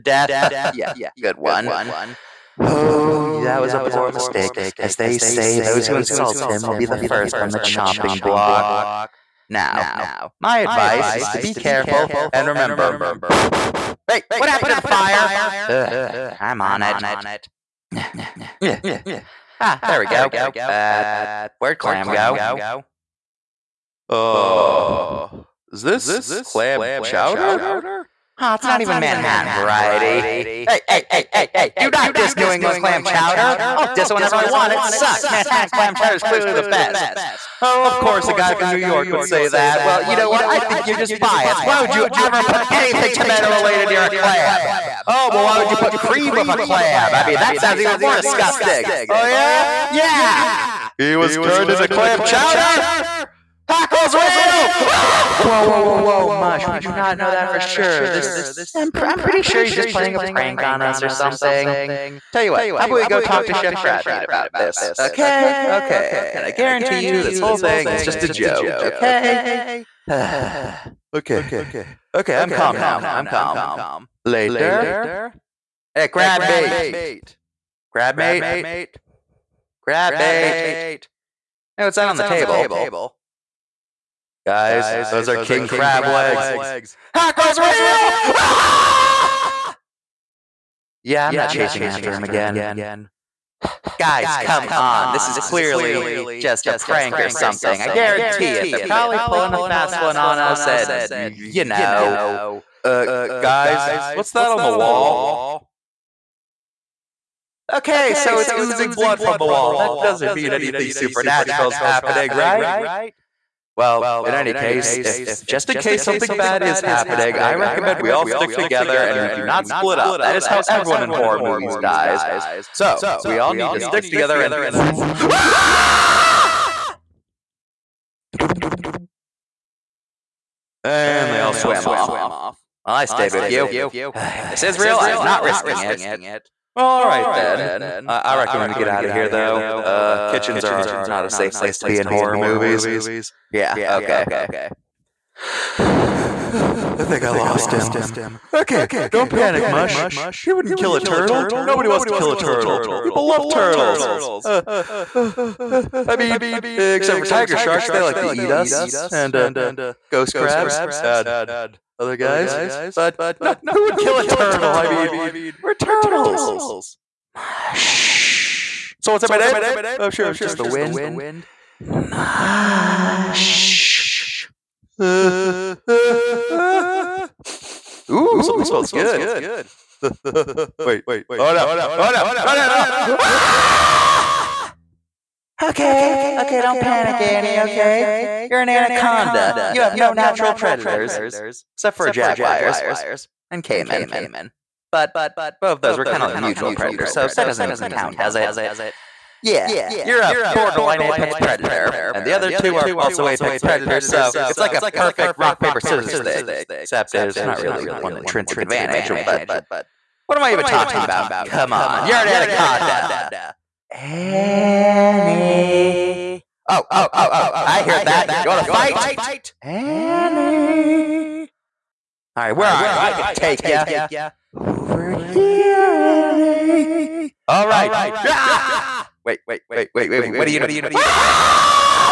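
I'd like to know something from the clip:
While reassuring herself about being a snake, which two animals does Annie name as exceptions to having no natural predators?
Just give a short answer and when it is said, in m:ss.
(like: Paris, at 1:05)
Jaguars and caiman, at 3:12.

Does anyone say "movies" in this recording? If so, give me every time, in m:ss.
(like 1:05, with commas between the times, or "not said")
2:01, 2:22.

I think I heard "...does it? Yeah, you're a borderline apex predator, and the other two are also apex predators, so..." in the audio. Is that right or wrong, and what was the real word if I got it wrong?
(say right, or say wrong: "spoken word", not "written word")
right.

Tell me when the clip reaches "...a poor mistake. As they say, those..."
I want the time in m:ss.
0:03.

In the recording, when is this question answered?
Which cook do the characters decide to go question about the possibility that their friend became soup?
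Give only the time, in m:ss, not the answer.
1:03.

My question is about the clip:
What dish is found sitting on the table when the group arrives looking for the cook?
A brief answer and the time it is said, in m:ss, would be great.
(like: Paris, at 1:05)
King crab legs, at 1:25.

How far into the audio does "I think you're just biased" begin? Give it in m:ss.
0:40.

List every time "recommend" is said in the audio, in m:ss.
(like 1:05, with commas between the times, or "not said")
1:57, 2:18.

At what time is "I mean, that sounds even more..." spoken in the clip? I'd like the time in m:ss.
0:47.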